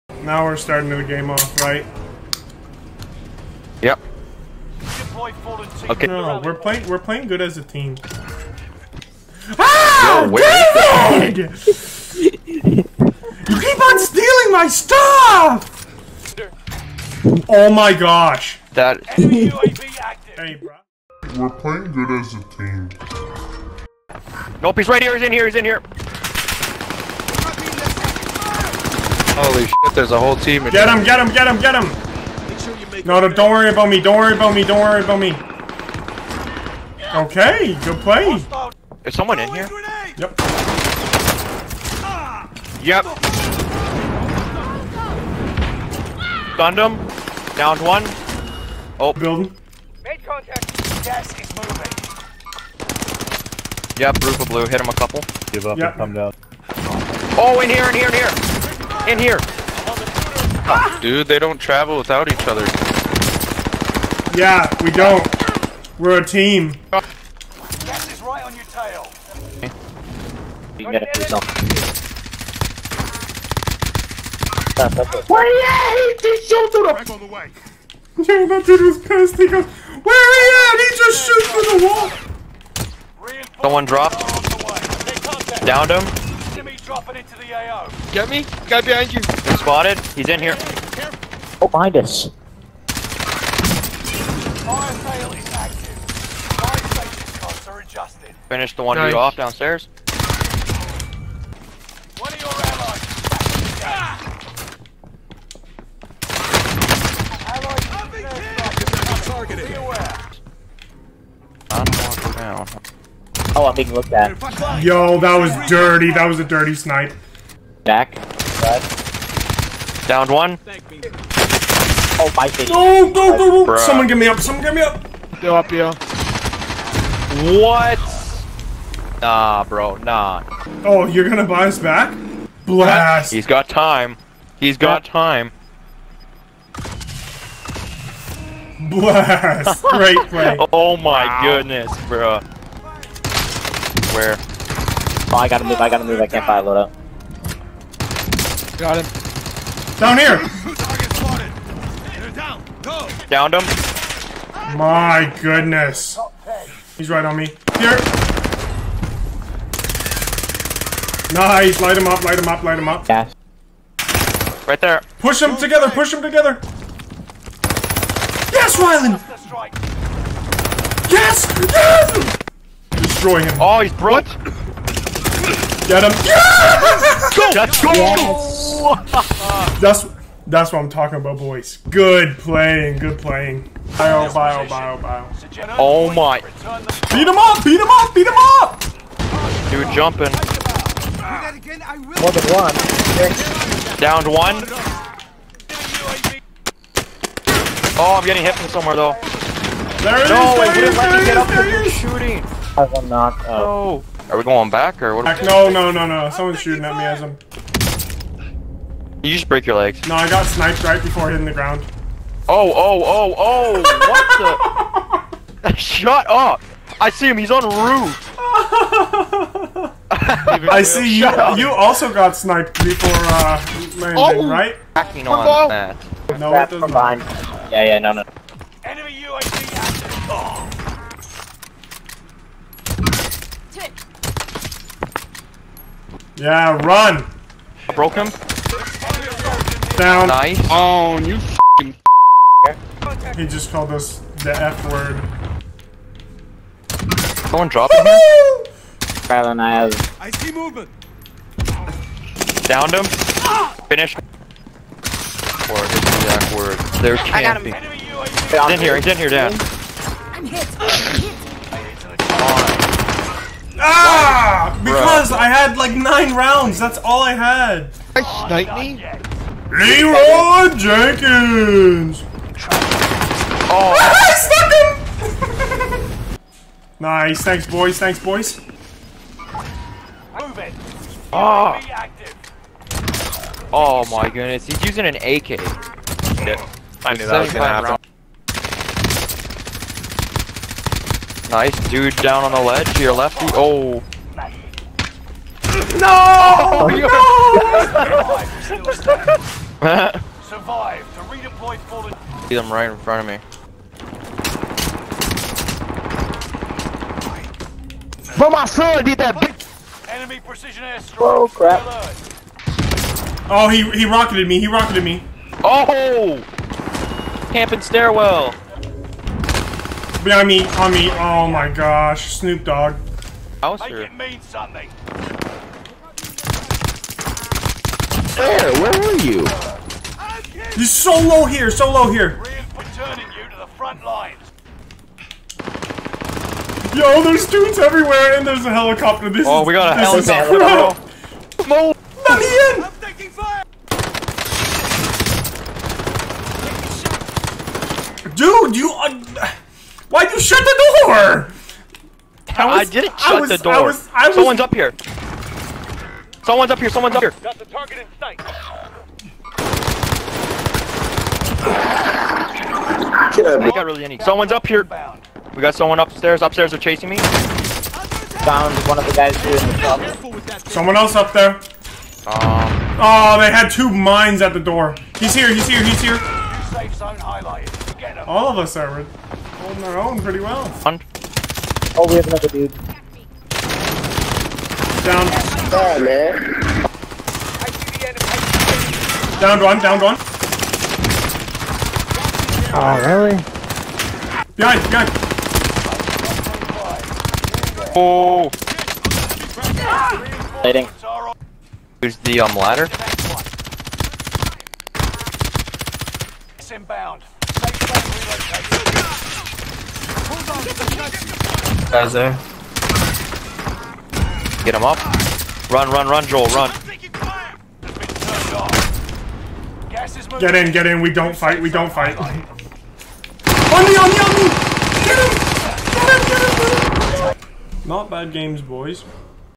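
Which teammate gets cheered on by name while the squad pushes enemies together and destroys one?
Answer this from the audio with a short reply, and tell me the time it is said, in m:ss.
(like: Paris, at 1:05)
Ryland, at 2:48.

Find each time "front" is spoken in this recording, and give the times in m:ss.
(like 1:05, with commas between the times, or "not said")
5:02, 5:33.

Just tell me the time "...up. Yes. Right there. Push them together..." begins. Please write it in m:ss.
2:42.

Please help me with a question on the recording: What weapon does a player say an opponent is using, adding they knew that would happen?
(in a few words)
AK.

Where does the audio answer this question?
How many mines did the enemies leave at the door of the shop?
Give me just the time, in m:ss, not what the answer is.
6:13.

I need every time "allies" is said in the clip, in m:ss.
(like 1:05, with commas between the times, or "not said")
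1:42, 1:47.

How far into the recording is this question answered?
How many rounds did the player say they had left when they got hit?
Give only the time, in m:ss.
4:25.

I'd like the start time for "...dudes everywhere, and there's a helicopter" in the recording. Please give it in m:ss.
5:37.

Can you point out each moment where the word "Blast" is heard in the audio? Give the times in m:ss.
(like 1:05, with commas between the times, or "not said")
2:12, 2:18.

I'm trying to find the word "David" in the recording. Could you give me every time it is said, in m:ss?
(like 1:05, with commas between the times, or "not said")
0:11.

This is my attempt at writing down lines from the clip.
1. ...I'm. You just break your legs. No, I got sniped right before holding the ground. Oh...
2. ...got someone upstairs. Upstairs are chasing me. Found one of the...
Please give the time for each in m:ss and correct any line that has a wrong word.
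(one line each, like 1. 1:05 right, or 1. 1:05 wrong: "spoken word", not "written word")
1. 3:27 wrong: "hitting", not "holding"
2. 6:05 right.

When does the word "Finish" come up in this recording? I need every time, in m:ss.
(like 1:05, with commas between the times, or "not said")
1:38, 4:13.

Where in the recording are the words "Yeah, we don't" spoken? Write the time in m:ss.
1:04.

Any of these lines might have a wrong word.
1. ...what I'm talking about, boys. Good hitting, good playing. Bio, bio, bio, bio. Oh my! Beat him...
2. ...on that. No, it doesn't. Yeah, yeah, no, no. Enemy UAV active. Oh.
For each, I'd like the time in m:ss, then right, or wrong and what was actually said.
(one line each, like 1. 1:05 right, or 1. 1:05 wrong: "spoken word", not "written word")
1. 3:00 wrong: "playing", not "hitting"
2. 3:45 right.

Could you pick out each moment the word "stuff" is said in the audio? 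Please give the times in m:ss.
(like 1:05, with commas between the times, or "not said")
0:14.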